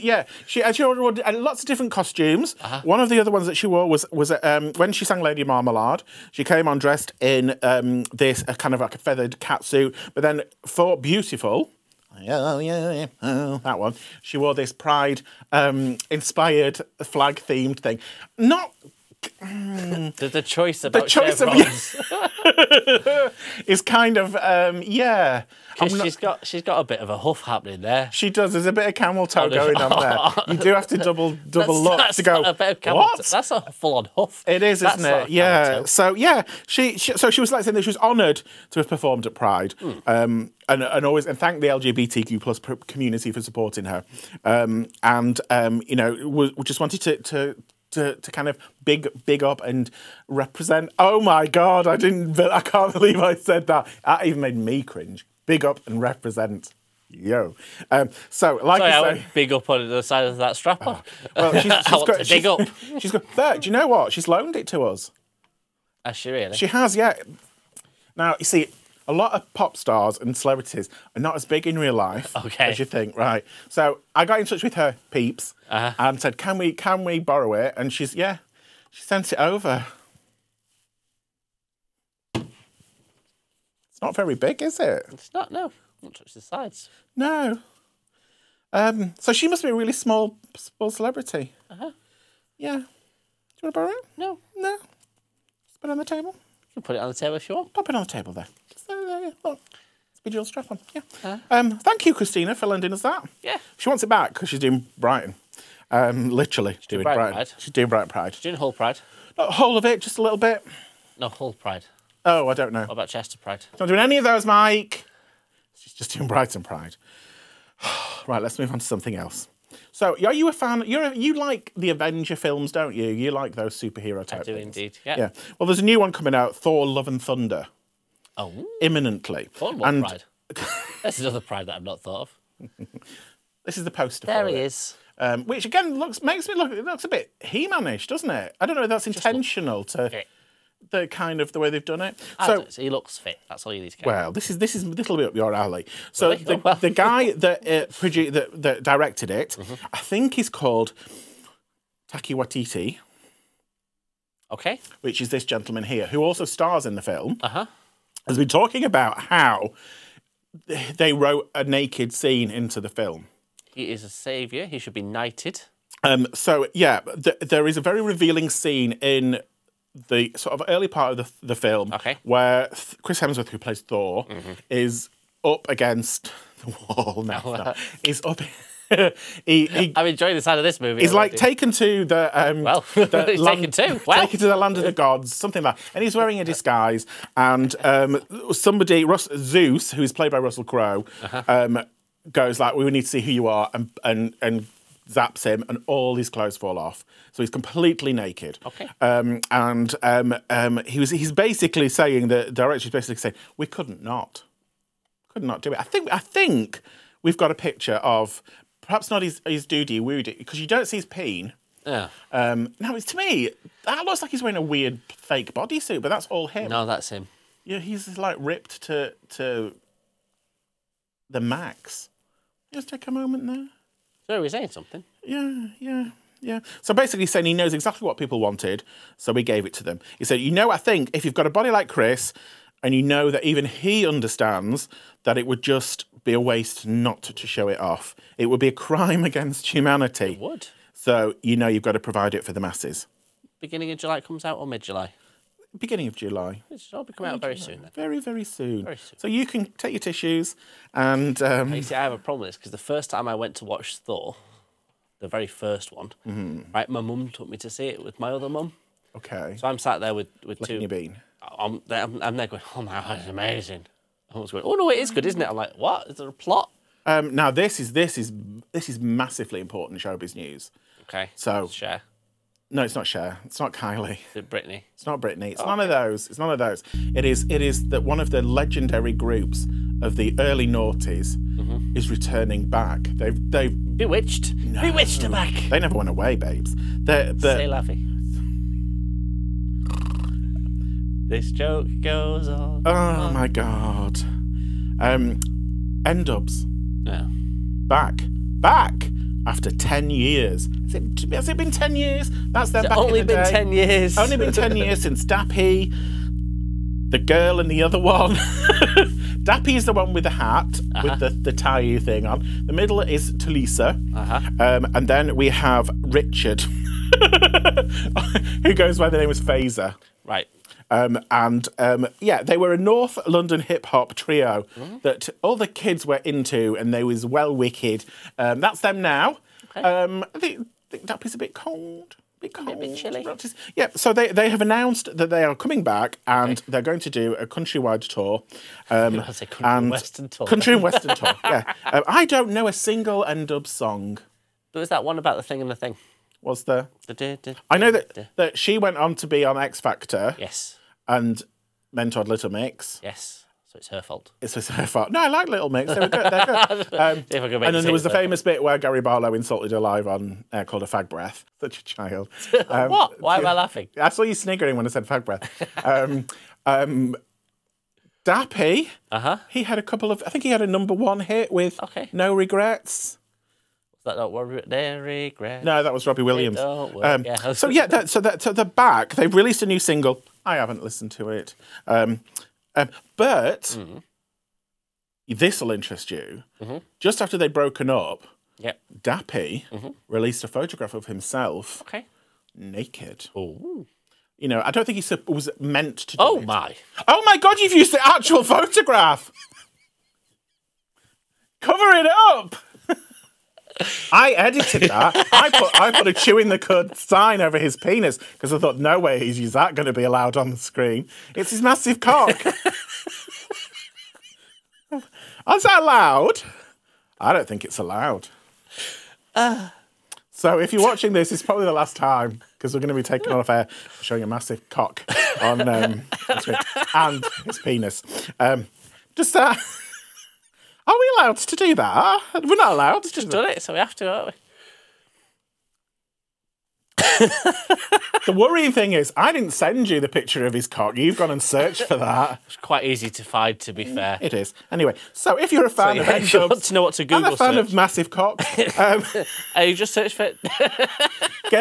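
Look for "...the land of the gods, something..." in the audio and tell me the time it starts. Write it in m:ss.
3:04.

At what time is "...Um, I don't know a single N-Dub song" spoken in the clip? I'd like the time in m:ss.
5:41.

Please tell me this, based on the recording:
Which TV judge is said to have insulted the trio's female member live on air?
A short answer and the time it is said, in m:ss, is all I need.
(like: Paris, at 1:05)
Gary Barlow, at 5:58.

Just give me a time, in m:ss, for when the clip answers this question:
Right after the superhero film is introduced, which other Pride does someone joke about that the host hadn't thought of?
2:09.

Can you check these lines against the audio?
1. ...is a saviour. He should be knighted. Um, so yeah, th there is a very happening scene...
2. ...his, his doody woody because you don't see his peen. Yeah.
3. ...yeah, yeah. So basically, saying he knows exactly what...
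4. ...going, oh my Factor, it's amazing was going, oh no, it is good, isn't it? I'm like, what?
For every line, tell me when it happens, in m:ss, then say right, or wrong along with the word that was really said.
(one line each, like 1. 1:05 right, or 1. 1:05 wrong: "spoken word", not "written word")
1. 2:43 wrong: "revealing", not "happening"
2. 3:29 right
3. 3:45 right
4. 4:22 wrong: "God", not "Factor".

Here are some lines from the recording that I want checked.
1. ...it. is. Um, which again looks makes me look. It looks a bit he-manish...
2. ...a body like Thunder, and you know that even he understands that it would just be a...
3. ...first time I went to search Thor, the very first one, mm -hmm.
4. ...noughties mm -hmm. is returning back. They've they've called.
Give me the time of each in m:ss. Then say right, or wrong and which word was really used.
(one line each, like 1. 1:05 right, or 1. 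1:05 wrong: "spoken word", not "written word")
1. 2:14 right
2. 3:51 wrong: "Chris", not "Thunder"
3. 4:12 wrong: "watch", not "search"
4. 4:40 wrong: "bewitched", not "called".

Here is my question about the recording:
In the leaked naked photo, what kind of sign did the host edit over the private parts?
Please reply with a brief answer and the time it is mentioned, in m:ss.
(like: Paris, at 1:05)
Chewing the cud sign, at 6:46.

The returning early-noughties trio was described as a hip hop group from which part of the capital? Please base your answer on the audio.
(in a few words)
North London.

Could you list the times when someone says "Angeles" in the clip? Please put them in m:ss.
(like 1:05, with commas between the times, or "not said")
not said.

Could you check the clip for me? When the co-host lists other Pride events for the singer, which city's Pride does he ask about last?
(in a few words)
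Chester.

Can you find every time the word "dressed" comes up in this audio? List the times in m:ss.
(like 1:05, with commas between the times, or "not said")
0:06.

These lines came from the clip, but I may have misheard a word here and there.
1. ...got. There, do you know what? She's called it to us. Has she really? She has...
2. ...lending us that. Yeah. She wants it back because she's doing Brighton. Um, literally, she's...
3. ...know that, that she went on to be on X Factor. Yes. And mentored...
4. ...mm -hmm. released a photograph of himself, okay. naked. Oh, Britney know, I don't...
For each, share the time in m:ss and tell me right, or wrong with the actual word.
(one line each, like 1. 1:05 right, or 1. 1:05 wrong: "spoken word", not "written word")
1. 1:03 wrong: "loaned", not "called"
2. 1:42 right
3. 5:47 right
4. 6:29 wrong: "You", not "Britney".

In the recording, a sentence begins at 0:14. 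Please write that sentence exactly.
She wore this pride um, inspired flag themed thing.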